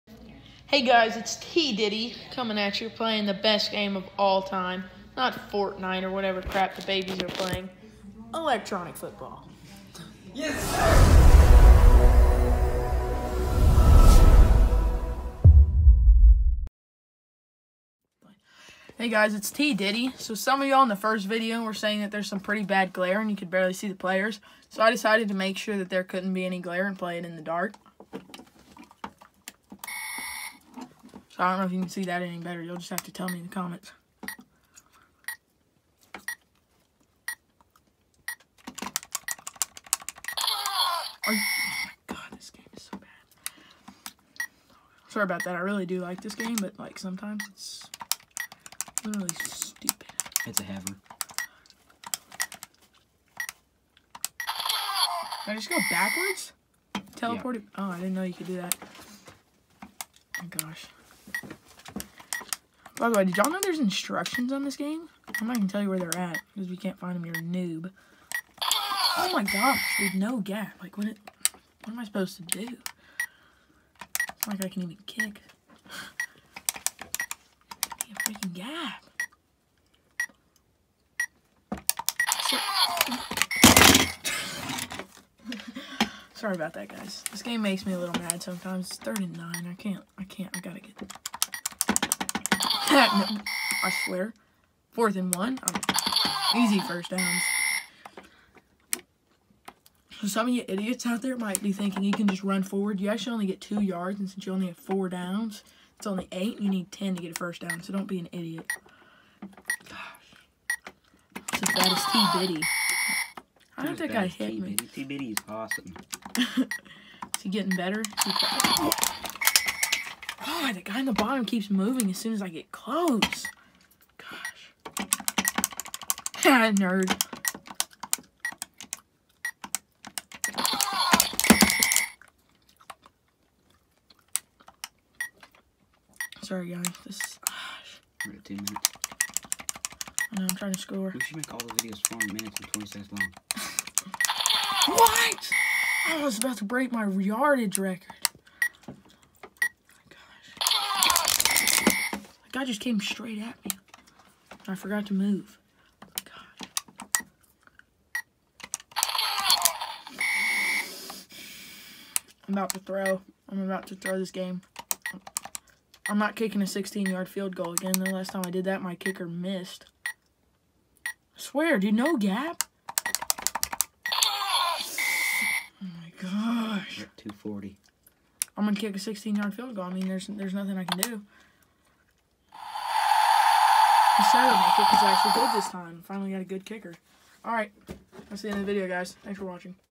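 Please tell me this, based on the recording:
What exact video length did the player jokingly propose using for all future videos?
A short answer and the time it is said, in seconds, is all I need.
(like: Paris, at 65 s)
4 minutes and 20 seconds, at 142 s.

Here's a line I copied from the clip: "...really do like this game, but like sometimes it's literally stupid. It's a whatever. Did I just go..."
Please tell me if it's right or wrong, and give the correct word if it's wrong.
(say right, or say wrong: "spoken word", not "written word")
wrong: "haver", not "whatever".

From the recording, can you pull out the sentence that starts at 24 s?
So I decided to make sure that there couldn't be any glare and play it in the dark.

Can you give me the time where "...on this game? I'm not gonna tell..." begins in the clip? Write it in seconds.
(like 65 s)
64 s.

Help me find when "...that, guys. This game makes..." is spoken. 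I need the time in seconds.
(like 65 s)
86 s.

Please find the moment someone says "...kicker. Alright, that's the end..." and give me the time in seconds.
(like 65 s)
186 s.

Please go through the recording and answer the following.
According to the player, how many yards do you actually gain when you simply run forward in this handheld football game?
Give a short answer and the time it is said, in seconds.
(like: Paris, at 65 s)
2, at 103 s.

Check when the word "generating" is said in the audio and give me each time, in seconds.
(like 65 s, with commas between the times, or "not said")
not said.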